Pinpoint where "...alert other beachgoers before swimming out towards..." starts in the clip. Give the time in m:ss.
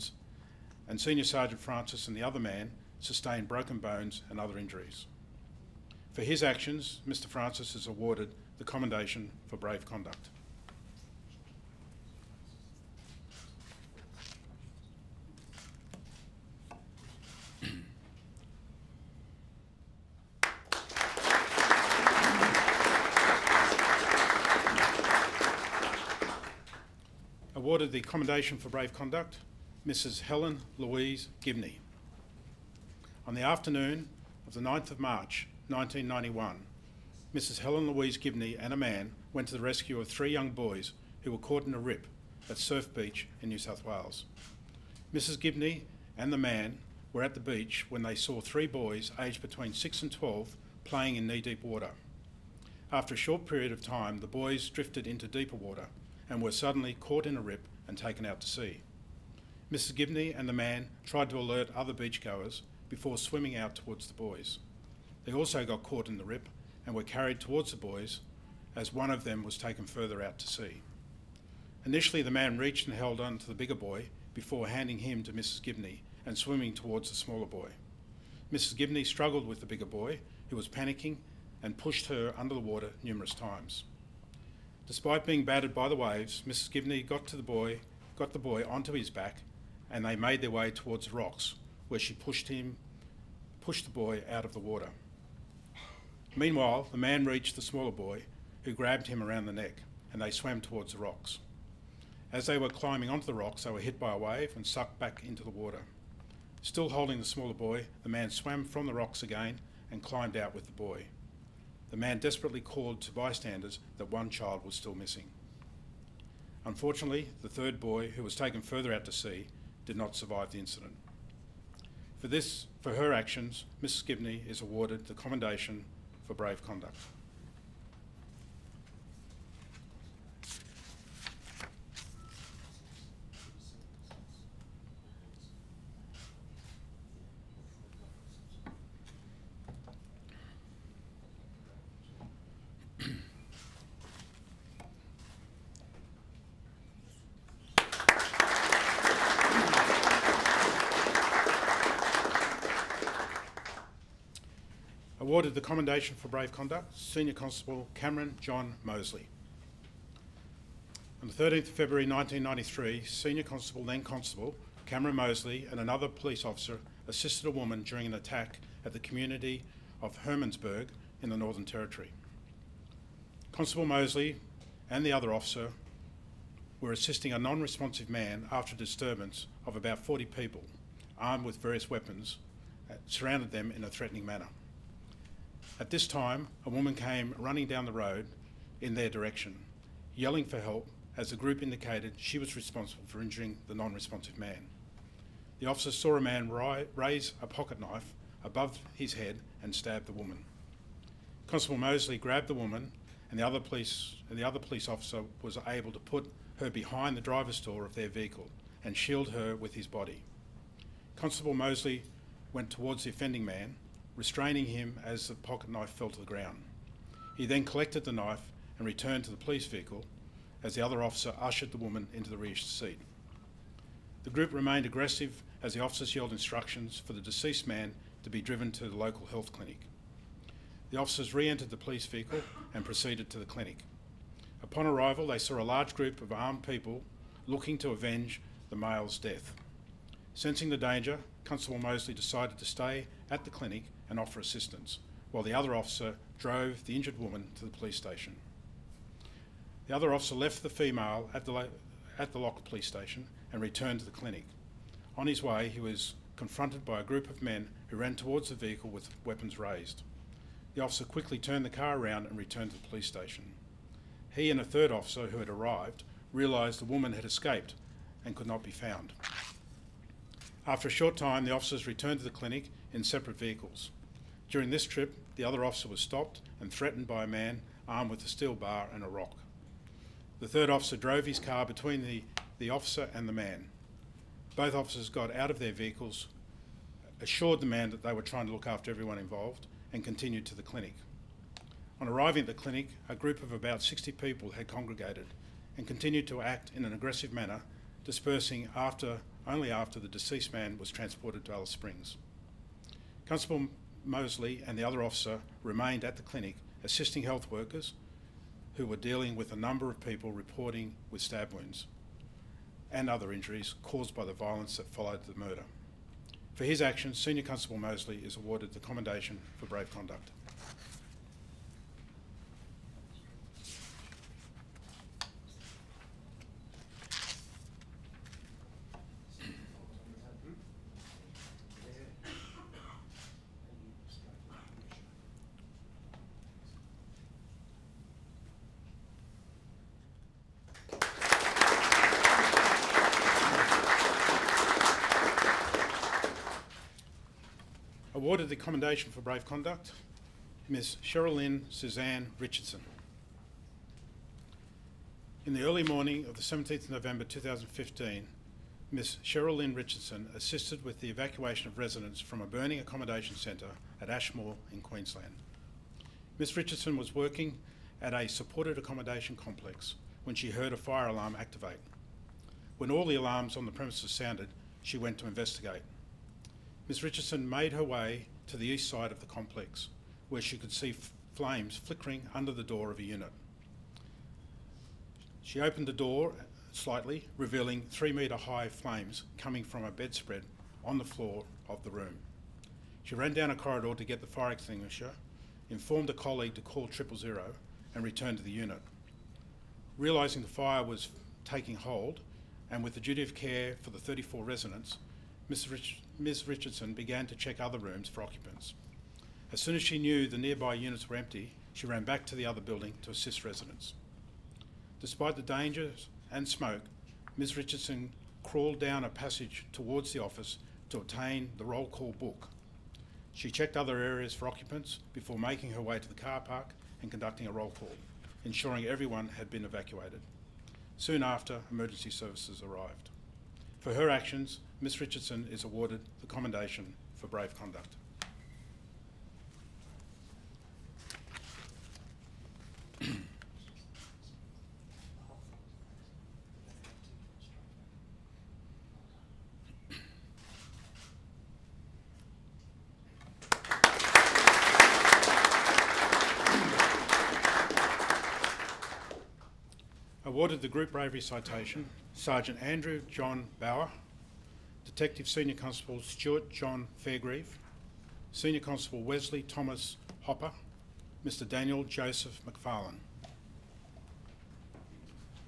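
1:01.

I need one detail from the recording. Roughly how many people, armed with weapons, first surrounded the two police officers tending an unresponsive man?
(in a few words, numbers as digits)
40.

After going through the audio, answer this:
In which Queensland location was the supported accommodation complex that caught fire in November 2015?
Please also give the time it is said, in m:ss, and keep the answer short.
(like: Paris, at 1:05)
Ashmore, at 6:04.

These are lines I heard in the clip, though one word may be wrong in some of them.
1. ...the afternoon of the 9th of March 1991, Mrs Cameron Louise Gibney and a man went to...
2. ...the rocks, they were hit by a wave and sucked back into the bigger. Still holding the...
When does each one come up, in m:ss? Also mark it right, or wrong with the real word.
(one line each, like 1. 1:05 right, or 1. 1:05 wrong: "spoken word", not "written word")
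1. 0:33 wrong: "Helen", not "Cameron"
2. 1:43 wrong: "water", not "bigger".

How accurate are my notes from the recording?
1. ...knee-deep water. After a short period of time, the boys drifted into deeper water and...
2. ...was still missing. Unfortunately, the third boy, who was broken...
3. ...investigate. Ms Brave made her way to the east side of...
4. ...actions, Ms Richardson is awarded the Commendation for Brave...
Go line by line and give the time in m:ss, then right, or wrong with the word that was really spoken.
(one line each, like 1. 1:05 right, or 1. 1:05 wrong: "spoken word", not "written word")
1. 0:51 right
2. 1:54 wrong: "taken", not "broken"
3. 6:15 wrong: "Richardson", not "Brave"
4. 7:14 right.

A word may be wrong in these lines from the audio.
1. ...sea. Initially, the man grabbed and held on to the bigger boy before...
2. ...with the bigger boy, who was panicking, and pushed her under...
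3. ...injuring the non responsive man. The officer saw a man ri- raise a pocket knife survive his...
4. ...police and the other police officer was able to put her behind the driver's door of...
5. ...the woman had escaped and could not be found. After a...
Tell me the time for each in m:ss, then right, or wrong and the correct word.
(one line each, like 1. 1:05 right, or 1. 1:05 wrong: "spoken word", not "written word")
1. 1:10 wrong: "reached", not "grabbed"
2. 1:19 right
3. 3:13 wrong: "above", not "survive"
4. 3:23 right
5. 4:26 right.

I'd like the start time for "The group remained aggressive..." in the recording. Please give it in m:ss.
3:44.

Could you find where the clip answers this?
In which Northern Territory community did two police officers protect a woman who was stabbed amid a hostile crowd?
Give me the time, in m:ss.
2:50.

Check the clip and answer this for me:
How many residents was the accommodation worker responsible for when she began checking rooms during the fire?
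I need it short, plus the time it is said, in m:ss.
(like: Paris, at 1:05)
34, at 6:43.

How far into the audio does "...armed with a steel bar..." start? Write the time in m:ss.
4:37.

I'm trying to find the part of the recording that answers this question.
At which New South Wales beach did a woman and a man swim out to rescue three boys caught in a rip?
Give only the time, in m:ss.
0:42.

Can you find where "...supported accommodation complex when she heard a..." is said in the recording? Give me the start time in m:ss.
6:08.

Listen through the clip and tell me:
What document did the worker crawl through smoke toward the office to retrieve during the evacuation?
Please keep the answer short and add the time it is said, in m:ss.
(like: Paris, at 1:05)
roll call book, at 7:01.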